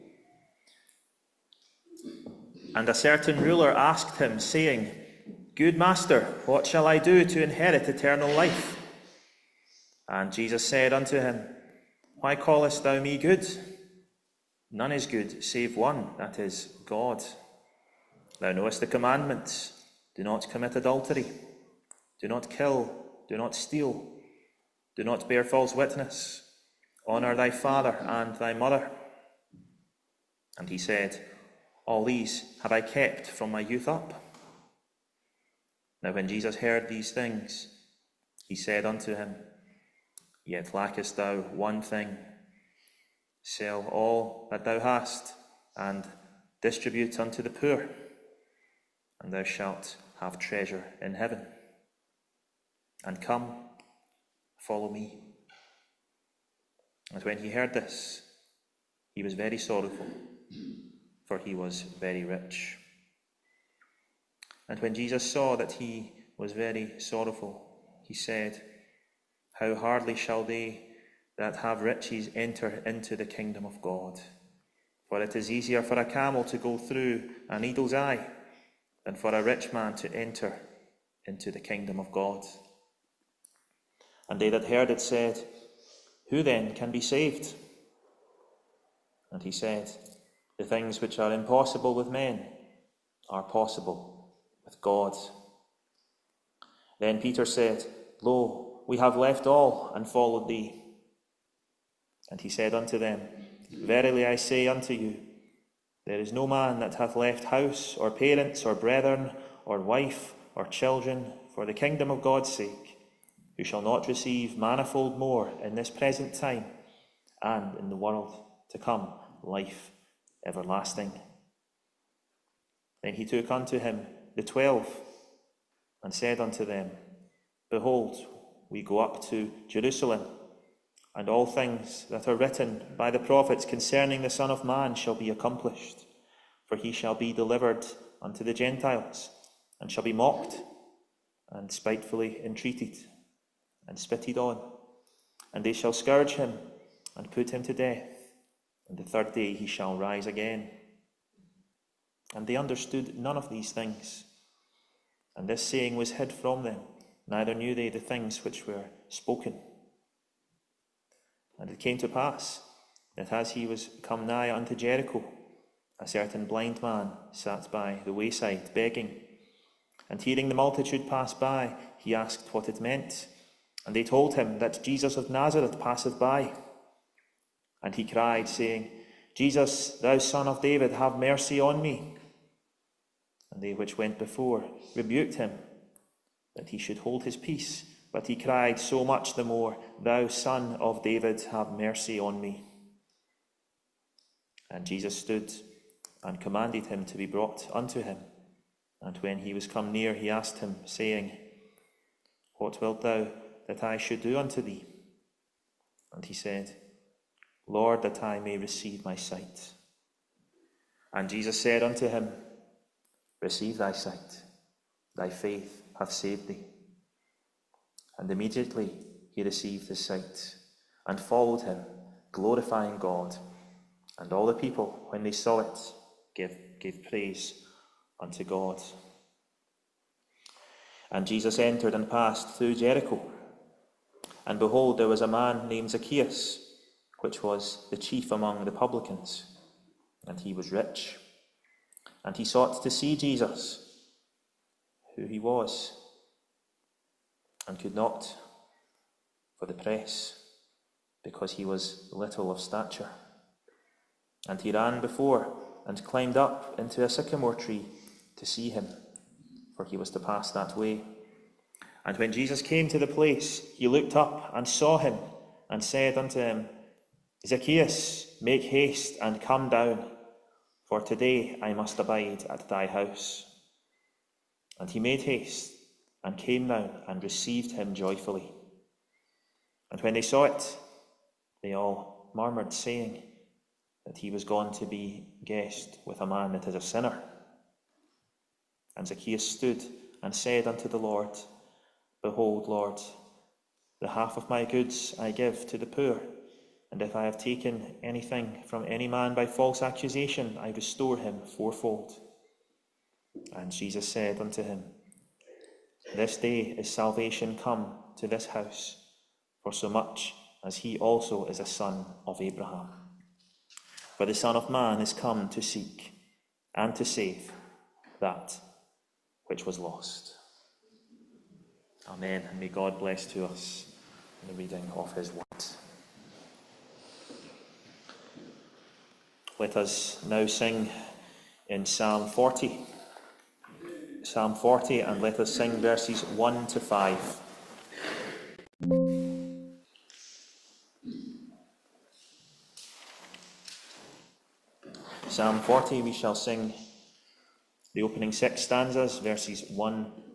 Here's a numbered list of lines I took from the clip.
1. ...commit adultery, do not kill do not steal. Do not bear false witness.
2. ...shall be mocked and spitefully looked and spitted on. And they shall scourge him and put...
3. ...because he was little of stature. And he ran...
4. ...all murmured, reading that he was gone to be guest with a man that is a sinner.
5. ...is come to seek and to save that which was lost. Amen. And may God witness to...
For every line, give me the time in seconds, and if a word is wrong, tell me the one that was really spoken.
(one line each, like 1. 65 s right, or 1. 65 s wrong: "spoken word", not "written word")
1. 20 s right
2. 139 s wrong: "entreated", not "looked"
3. 251 s right
4. 281 s wrong: "saying", not "reading"
5. 314 s wrong: "bless", not "witness".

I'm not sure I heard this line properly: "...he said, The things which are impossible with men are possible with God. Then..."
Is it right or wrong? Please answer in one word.
right.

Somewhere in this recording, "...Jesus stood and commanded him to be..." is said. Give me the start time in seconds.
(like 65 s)
194 s.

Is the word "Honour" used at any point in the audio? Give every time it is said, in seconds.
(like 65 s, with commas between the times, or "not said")
27 s.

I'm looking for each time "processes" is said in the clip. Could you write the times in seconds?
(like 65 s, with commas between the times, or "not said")
not said.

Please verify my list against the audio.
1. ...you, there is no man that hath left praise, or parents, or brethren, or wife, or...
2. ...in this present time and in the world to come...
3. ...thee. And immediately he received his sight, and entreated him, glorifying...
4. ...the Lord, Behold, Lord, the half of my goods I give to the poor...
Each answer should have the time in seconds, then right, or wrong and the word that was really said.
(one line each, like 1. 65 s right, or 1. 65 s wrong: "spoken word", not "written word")
1. 104 s wrong: "house", not "praise"
2. 115 s right
3. 216 s wrong: "followed", not "entreated"
4. 290 s right.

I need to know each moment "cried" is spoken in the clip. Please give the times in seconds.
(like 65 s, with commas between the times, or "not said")
178 s, 188 s.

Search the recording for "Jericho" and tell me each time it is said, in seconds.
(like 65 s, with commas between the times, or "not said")
164 s, 232 s.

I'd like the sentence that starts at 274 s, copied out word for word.
And he made haste and came down and received him joyfully.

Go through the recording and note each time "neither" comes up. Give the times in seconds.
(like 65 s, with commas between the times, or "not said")
157 s.